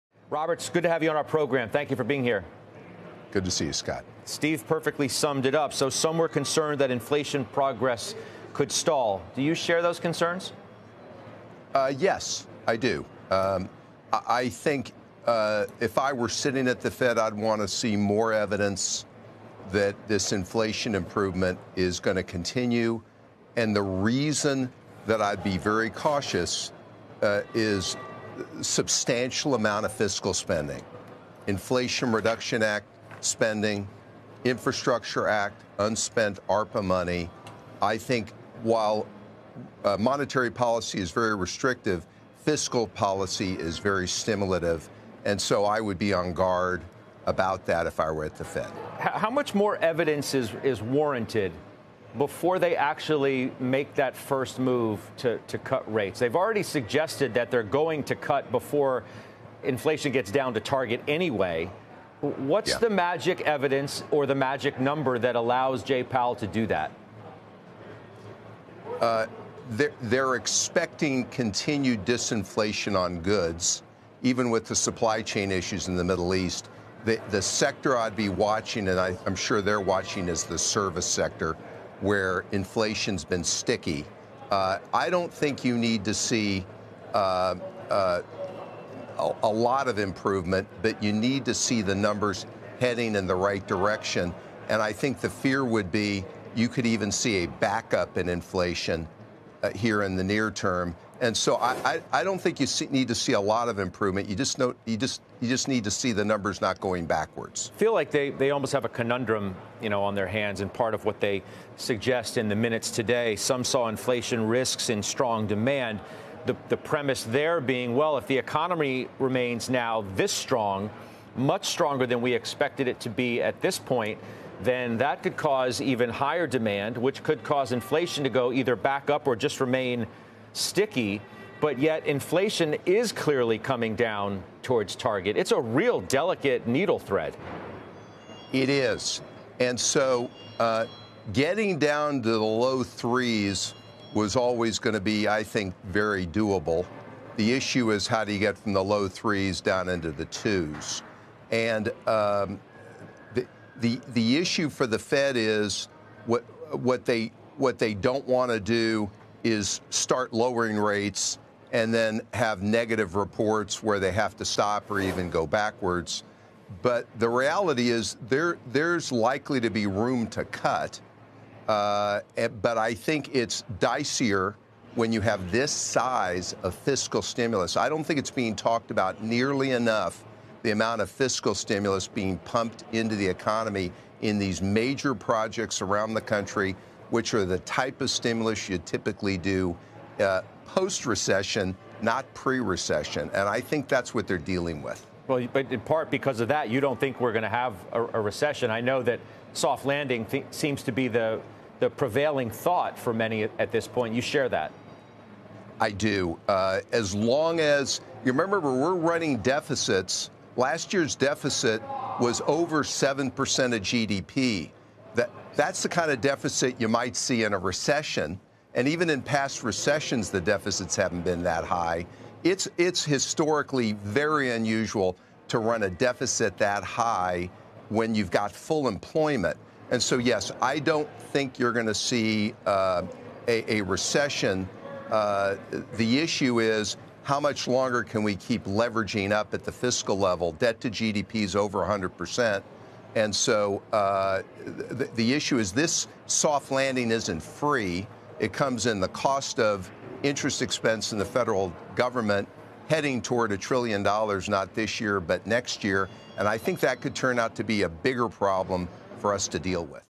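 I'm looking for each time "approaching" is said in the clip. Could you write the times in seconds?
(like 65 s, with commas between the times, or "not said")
not said.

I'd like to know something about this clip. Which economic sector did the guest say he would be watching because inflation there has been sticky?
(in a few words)
Service sector.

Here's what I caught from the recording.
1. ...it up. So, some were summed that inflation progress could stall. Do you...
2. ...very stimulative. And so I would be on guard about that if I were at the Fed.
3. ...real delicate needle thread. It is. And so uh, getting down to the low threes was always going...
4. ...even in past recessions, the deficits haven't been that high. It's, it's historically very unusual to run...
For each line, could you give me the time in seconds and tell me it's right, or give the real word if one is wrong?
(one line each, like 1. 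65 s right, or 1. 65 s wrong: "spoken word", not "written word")
1. 5 s wrong: "concerned", not "summed"
2. 43 s right
3. 135 s right
4. 218 s right.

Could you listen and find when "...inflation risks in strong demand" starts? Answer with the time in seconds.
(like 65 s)
113 s.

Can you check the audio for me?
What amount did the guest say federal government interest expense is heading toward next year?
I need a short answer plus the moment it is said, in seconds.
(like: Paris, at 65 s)
A trillion dollars, at 253 s.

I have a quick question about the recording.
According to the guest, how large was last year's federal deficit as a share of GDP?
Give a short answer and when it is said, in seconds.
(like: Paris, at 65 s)
Over 7%, at 212 s.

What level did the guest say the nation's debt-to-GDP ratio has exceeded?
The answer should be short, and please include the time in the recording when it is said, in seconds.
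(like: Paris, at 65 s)
100 percent, at 241 s.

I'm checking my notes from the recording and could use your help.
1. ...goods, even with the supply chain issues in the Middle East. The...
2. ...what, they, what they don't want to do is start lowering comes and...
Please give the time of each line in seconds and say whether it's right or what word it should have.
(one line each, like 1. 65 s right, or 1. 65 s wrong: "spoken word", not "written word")
1. 73 s right
2. 156 s wrong: "rates", not "comes".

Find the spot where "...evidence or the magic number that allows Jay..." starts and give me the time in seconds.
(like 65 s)
63 s.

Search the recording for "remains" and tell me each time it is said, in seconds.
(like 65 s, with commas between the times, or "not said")
119 s, 129 s.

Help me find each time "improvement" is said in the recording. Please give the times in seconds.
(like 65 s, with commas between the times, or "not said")
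20 s, 89 s, 103 s.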